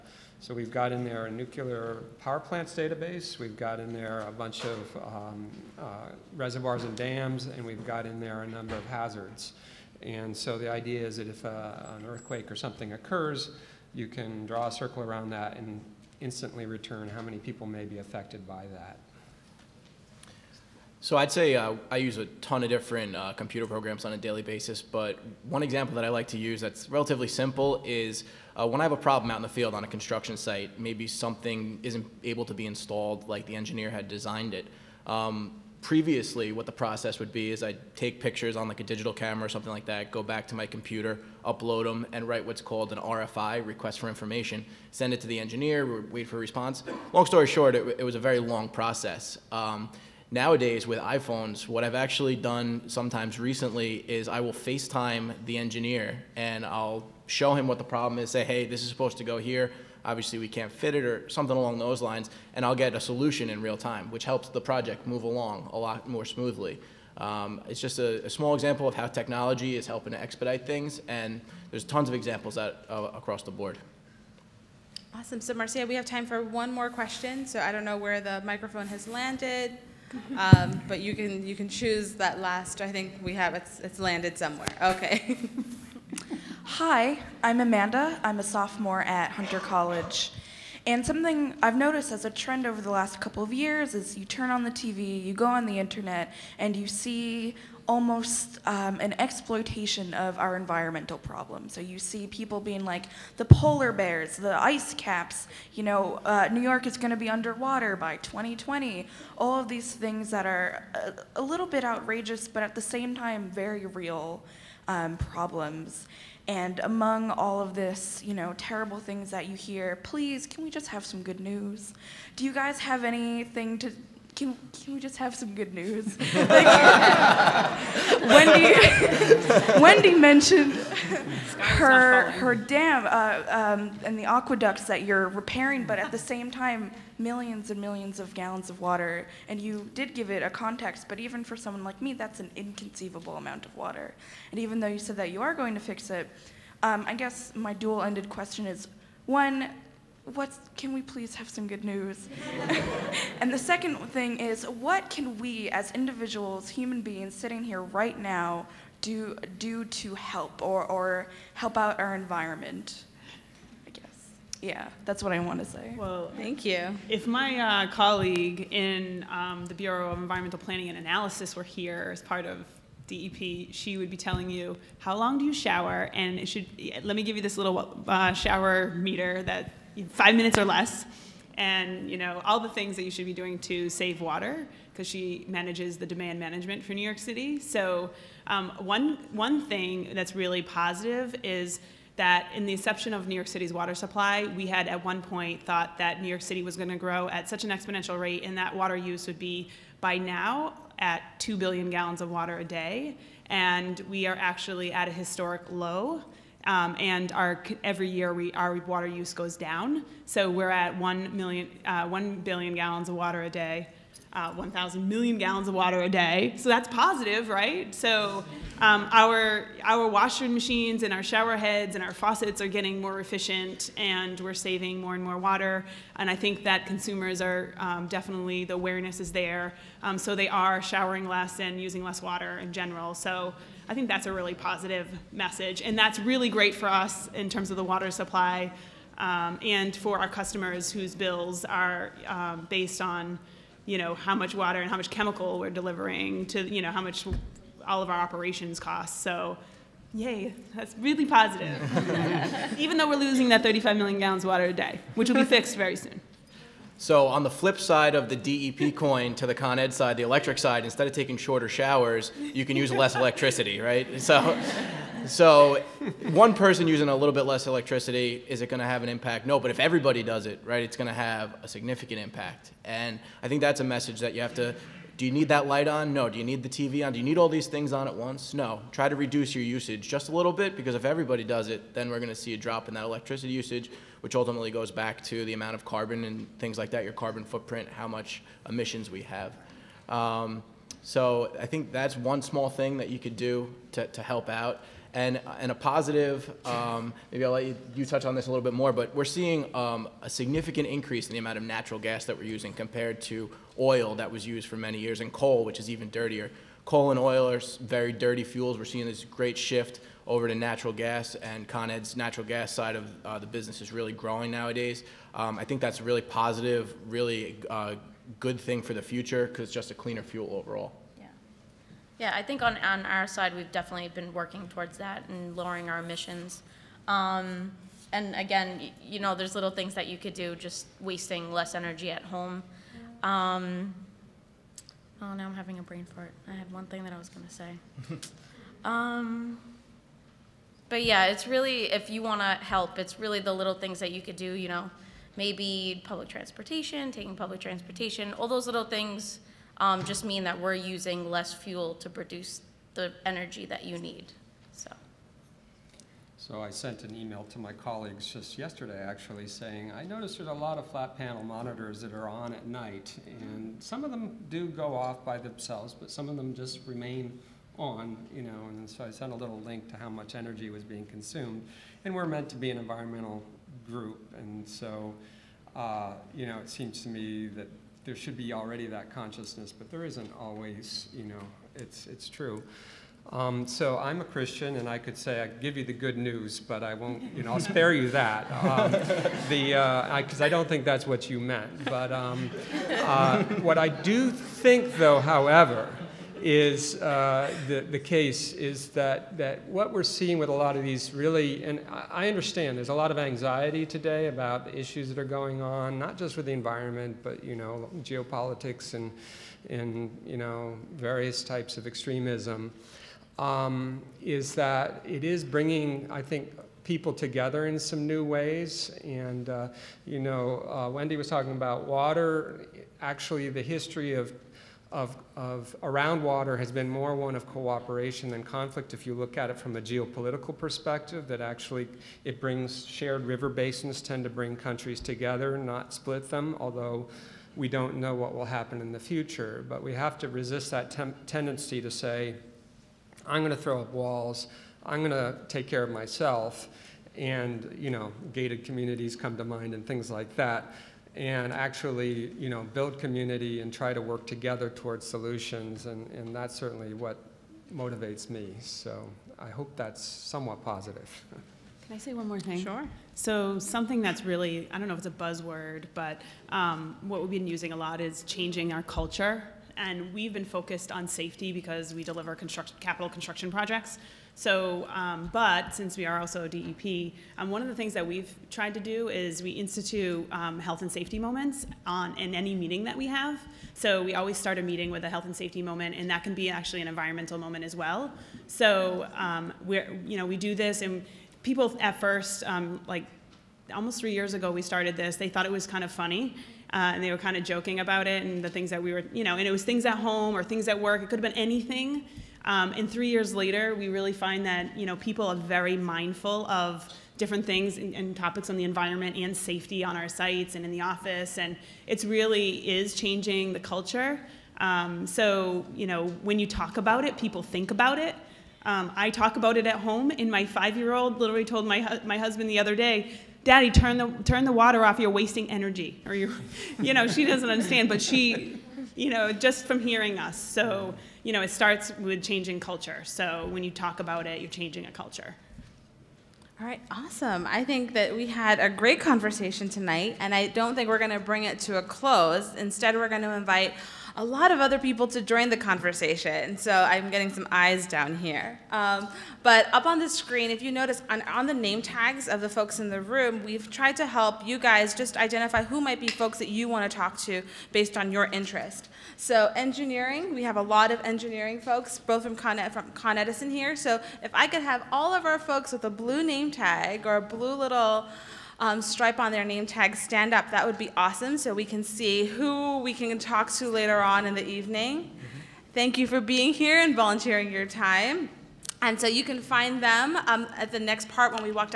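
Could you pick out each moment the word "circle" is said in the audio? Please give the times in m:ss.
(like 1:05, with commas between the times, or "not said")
0:14.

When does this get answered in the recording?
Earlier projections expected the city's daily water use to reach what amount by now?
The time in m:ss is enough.
3:21.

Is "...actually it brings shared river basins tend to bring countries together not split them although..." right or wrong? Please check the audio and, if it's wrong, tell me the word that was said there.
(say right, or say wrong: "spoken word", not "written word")
right.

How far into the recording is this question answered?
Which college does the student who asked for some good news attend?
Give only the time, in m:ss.
1:29.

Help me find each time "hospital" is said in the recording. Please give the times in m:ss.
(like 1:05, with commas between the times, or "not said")
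not said.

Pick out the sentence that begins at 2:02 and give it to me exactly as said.
Do you guys have anything to can, can we just have some good news?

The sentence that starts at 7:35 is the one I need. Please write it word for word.
And, and that's certainly what motivates me.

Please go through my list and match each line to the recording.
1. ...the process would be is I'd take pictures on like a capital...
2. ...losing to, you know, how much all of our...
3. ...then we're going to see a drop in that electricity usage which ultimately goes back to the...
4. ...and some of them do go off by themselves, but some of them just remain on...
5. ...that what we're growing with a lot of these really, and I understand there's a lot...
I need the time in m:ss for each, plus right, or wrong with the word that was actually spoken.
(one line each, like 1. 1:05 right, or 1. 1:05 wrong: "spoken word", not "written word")
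1. 0:36 wrong: "digital", not "capital"
2. 4:05 wrong: "delivering", not "losing"
3. 4:41 right
4. 6:03 right
5. 6:39 wrong: "seeing", not "growing".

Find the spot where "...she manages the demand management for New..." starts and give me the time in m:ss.
3:05.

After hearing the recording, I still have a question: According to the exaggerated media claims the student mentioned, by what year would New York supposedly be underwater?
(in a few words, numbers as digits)
2020.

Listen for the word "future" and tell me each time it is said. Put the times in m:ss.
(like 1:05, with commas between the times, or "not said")
5:19, 7:18.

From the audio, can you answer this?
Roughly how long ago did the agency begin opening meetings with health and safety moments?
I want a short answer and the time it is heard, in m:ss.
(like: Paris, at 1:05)
3 years, at 8:13.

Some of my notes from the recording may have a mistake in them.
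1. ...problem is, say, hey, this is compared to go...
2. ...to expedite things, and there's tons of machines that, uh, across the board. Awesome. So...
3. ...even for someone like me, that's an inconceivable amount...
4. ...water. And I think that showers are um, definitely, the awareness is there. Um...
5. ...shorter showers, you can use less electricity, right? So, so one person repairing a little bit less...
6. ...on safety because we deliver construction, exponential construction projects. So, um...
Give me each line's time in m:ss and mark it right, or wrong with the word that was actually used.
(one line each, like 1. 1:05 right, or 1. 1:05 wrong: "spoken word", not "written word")
1. 0:57 wrong: "supposed", not "compared"
2. 1:10 wrong: "examples", not "machines"
3. 2:21 right
4. 3:45 wrong: "consumers", not "showers"
5. 4:21 wrong: "using", not "repairing"
6. 7:50 wrong: "capital", not "exponential".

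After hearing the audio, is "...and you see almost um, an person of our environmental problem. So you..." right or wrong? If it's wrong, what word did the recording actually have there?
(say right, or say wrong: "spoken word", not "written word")
wrong: "exploitation", not "person".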